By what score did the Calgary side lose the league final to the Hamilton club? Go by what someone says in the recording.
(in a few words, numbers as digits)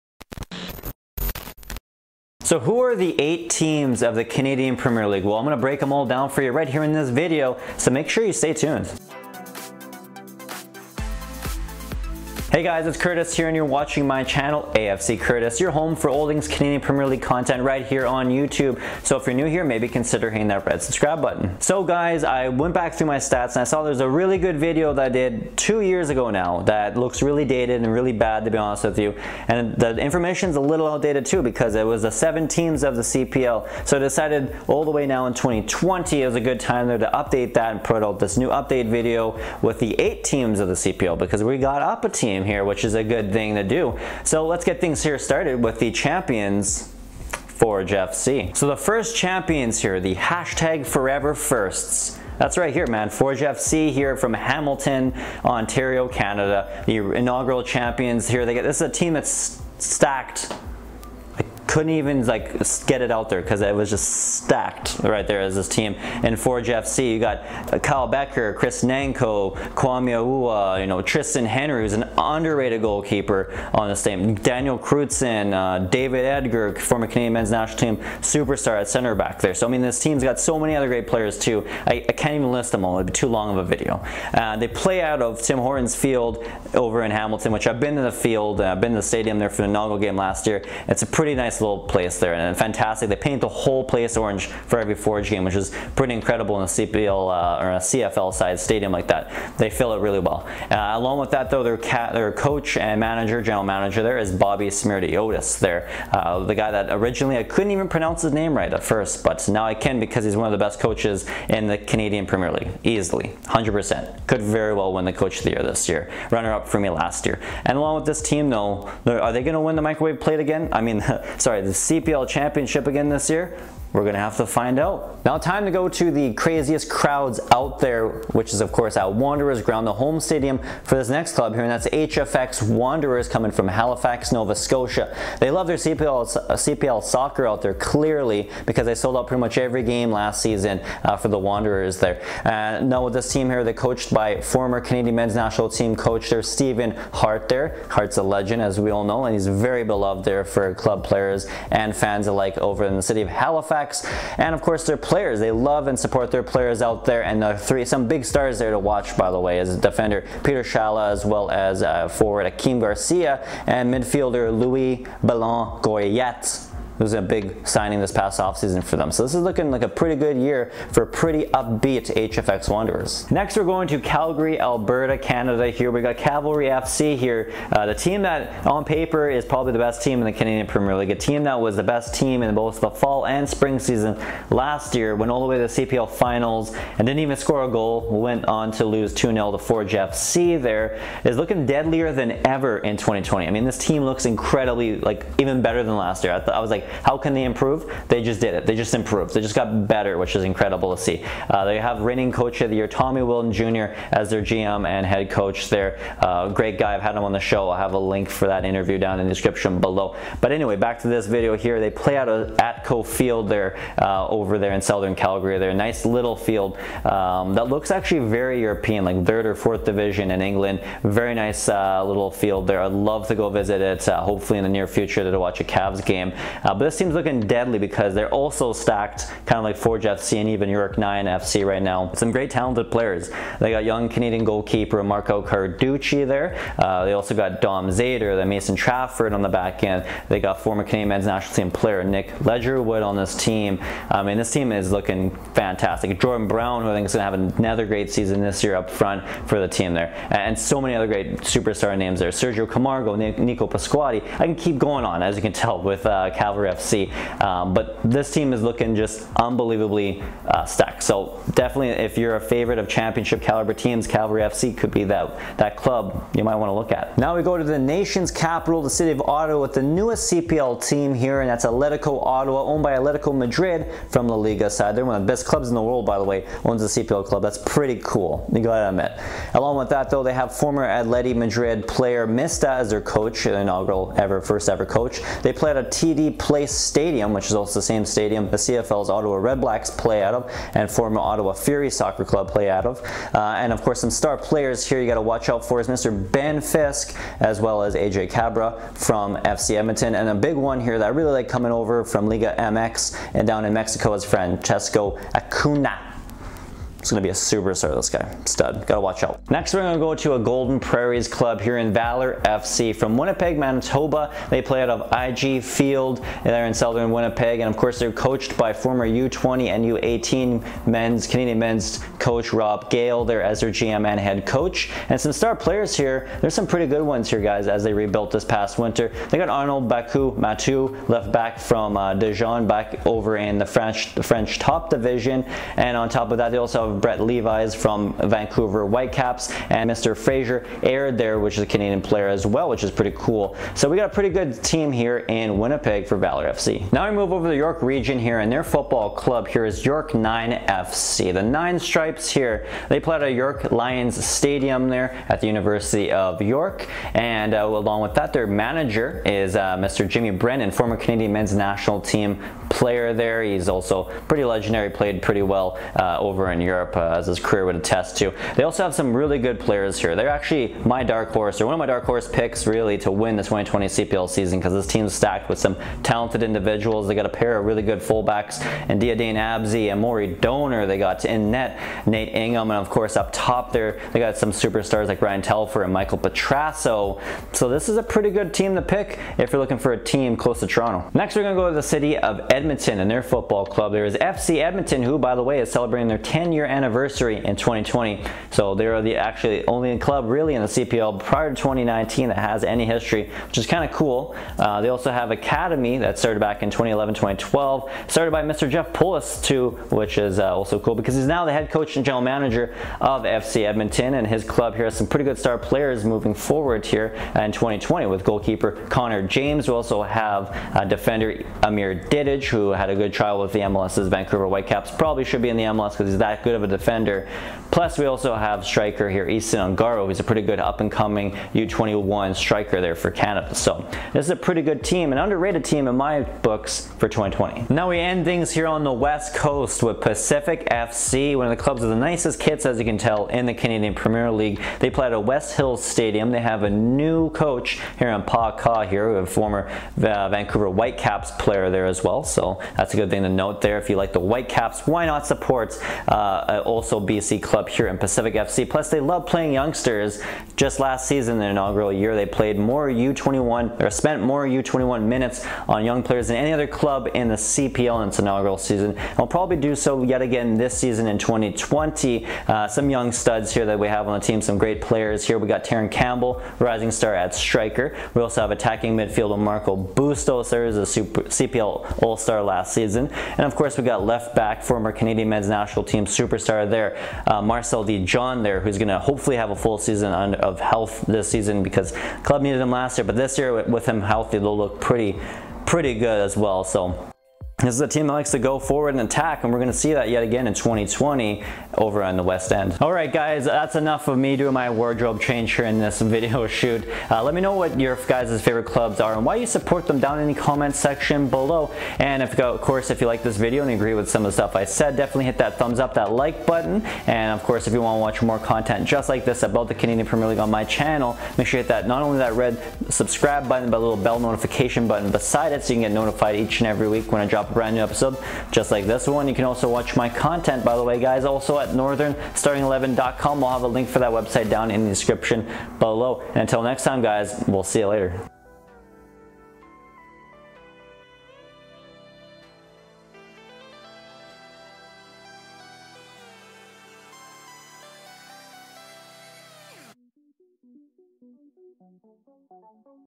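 2-0.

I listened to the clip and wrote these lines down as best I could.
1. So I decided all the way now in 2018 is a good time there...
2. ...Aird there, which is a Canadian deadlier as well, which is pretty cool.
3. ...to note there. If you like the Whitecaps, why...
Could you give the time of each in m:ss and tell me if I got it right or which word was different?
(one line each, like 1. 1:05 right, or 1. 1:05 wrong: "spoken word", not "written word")
1. 0:33 wrong: "2020", not "2018"
2. 5:40 wrong: "player", not "deadlier"
3. 7:33 right.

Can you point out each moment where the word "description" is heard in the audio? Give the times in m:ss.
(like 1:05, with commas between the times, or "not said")
3:29, 8:54.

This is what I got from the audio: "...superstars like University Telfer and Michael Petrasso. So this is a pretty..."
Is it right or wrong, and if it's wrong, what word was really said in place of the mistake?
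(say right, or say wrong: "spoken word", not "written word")
wrong: "Ryan", not "University".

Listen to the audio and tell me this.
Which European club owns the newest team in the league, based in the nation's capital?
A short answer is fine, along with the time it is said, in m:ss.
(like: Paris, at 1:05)
Atletico Madrid, at 4:32.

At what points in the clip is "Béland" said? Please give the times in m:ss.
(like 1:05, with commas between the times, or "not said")
2:45.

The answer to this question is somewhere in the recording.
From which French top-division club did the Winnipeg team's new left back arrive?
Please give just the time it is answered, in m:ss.
5:32.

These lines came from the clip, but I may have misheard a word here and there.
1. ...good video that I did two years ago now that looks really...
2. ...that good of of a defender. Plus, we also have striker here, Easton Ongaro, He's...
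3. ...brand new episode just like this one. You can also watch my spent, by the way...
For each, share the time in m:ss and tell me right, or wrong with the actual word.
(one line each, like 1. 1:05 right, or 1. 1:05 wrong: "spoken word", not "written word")
1. 0:24 right
2. 7:06 right
3. 8:47 wrong: "content", not "spent".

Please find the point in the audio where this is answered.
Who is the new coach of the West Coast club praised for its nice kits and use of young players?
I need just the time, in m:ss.
7:28.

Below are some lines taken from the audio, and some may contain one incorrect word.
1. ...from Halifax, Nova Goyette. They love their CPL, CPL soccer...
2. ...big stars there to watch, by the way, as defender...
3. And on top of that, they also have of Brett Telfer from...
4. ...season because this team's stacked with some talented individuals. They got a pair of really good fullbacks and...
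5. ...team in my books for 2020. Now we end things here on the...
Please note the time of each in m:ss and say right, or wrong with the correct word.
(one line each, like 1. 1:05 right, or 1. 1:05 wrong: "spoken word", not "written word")
1. 2:13 wrong: "Scotia", not "Goyette"
2. 2:38 right
3. 5:35 wrong: "Levis", not "Telfer"
4. 6:14 right
5. 7:15 right.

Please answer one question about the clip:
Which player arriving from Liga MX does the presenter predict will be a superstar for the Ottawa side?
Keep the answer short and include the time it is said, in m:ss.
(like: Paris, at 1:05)
Francesco Acuna, at 5:04.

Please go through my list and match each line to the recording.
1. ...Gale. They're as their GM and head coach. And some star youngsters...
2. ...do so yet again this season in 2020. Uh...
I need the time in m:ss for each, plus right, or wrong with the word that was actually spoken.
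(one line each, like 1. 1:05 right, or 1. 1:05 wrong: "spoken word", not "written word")
1. 5:22 wrong: "players", not "youngsters"
2. 7:49 right.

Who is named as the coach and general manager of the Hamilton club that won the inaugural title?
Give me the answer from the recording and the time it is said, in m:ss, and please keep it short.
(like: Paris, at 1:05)
Bobby Smirty, at 1:44.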